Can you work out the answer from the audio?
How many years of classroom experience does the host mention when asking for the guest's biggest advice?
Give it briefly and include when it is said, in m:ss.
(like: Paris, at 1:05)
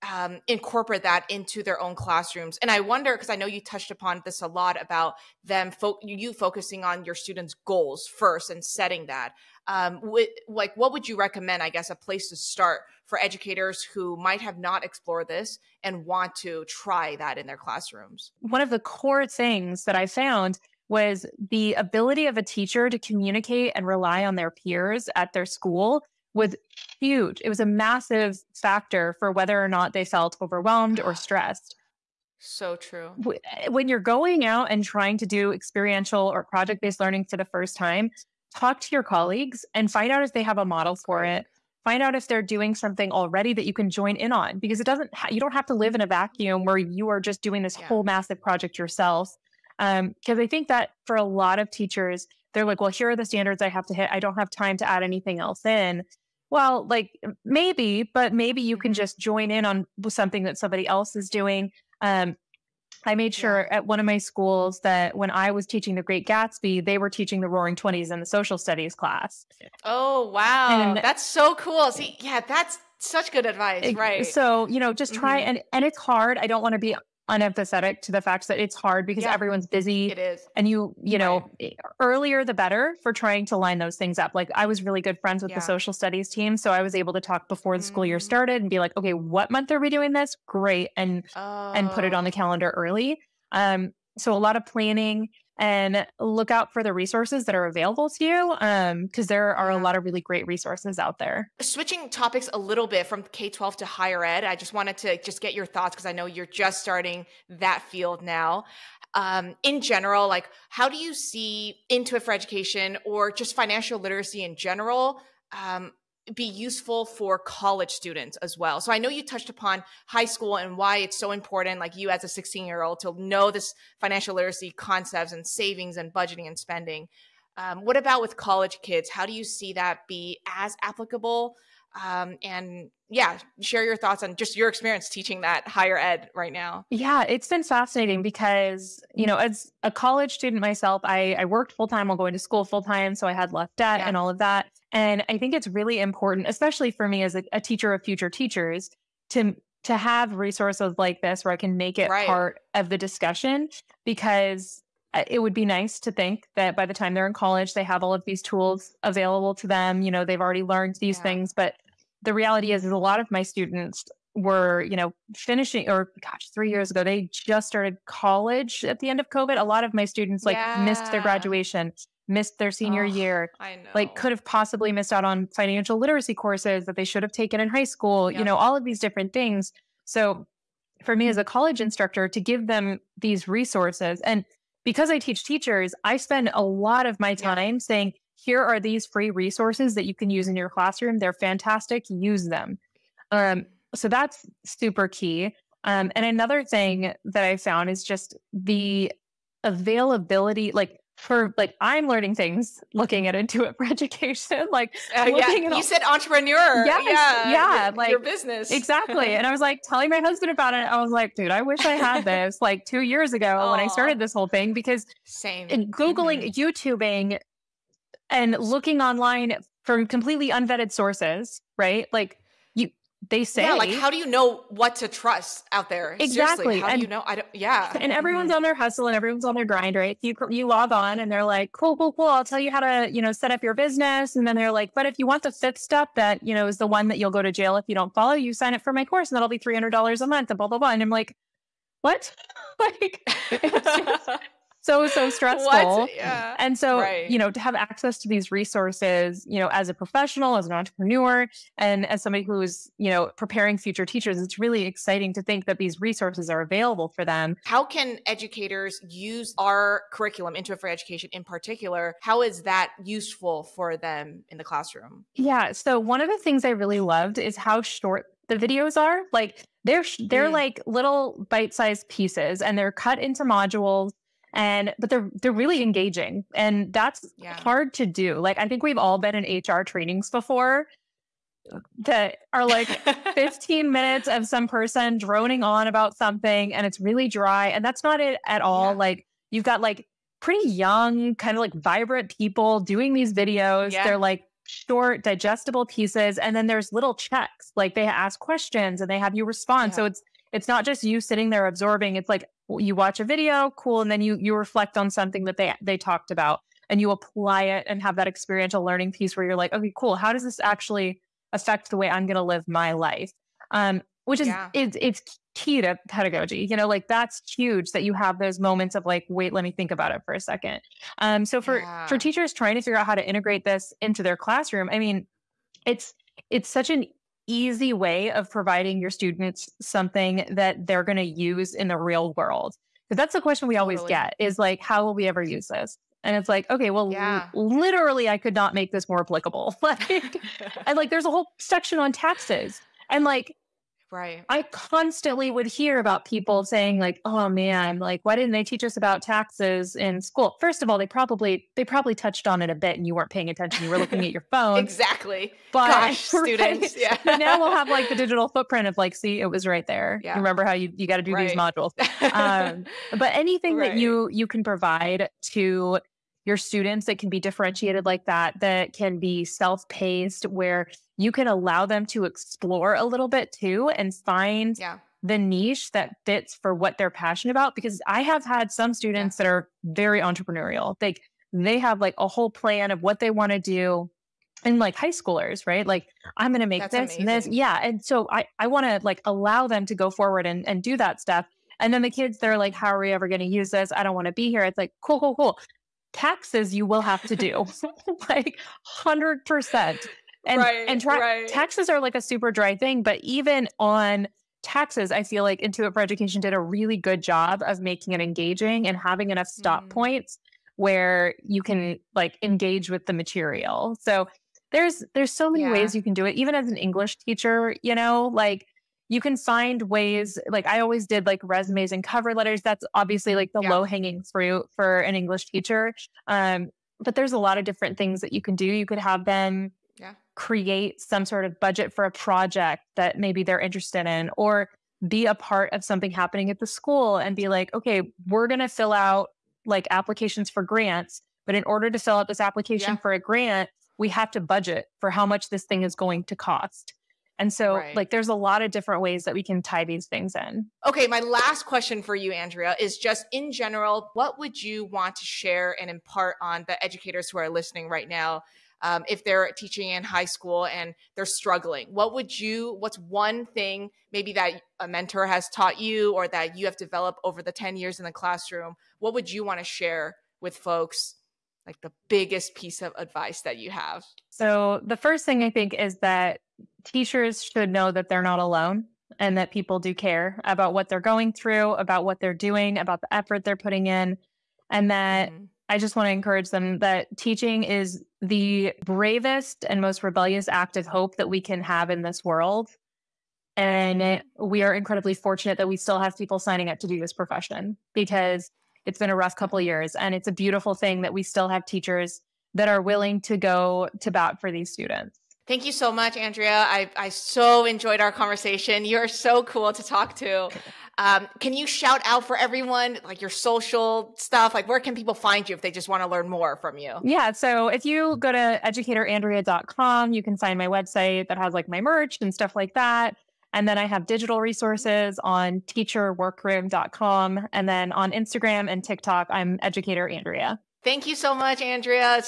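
10, at 7:47.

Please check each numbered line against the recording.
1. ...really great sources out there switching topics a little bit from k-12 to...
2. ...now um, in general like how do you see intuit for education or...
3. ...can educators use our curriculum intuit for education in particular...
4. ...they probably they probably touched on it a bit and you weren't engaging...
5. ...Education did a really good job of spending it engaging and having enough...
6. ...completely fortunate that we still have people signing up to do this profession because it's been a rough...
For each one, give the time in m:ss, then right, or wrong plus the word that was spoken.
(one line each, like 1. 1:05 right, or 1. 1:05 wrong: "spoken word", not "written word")
1. 1:40 wrong: "resources", not "sources"
2. 1:48 right
3. 4:17 right
4. 5:50 wrong: "paying", not "engaging"
5. 6:45 wrong: "making", not "spending"
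6. 8:14 wrong: "incredibly", not "completely".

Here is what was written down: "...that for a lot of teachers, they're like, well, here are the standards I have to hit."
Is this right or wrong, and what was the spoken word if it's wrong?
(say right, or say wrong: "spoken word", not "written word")
right.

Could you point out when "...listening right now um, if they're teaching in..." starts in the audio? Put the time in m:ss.
7:37.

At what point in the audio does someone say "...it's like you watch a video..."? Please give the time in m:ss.
5:02.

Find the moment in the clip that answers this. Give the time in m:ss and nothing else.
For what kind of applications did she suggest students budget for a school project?
7:20.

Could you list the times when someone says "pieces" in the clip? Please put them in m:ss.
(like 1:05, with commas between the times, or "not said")
4:32, 4:55, 5:09, 7:52.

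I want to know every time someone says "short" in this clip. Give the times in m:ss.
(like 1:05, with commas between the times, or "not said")
4:27, 4:54.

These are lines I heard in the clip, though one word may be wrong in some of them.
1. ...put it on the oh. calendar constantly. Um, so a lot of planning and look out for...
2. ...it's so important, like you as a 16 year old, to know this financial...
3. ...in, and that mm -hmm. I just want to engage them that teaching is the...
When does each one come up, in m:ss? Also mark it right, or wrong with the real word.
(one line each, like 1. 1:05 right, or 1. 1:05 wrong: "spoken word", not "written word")
1. 1:31 wrong: "early", not "constantly"
2. 2:00 right
3. 8:03 wrong: "encourage", not "engage".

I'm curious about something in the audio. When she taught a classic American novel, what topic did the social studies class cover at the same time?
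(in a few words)
Roaring Twenties.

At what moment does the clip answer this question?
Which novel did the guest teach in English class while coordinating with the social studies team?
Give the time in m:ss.
1:06.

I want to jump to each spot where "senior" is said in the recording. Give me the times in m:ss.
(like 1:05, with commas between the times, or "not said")
2:52.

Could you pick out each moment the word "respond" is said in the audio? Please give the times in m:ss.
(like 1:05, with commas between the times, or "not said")
4:59.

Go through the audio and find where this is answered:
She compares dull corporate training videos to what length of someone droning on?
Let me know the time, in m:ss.
4:43.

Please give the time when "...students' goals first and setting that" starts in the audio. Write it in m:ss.
0:07.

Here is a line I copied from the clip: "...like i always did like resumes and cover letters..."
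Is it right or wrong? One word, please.
right.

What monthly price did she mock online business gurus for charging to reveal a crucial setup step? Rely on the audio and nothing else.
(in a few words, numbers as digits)
$300 a month.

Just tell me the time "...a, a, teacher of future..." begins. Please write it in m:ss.
2:27.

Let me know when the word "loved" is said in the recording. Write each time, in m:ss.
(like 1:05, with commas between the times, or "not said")
4:26.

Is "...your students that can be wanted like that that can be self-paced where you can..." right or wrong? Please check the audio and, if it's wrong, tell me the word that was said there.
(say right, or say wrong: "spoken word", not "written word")
wrong: "differentiated", not "wanted".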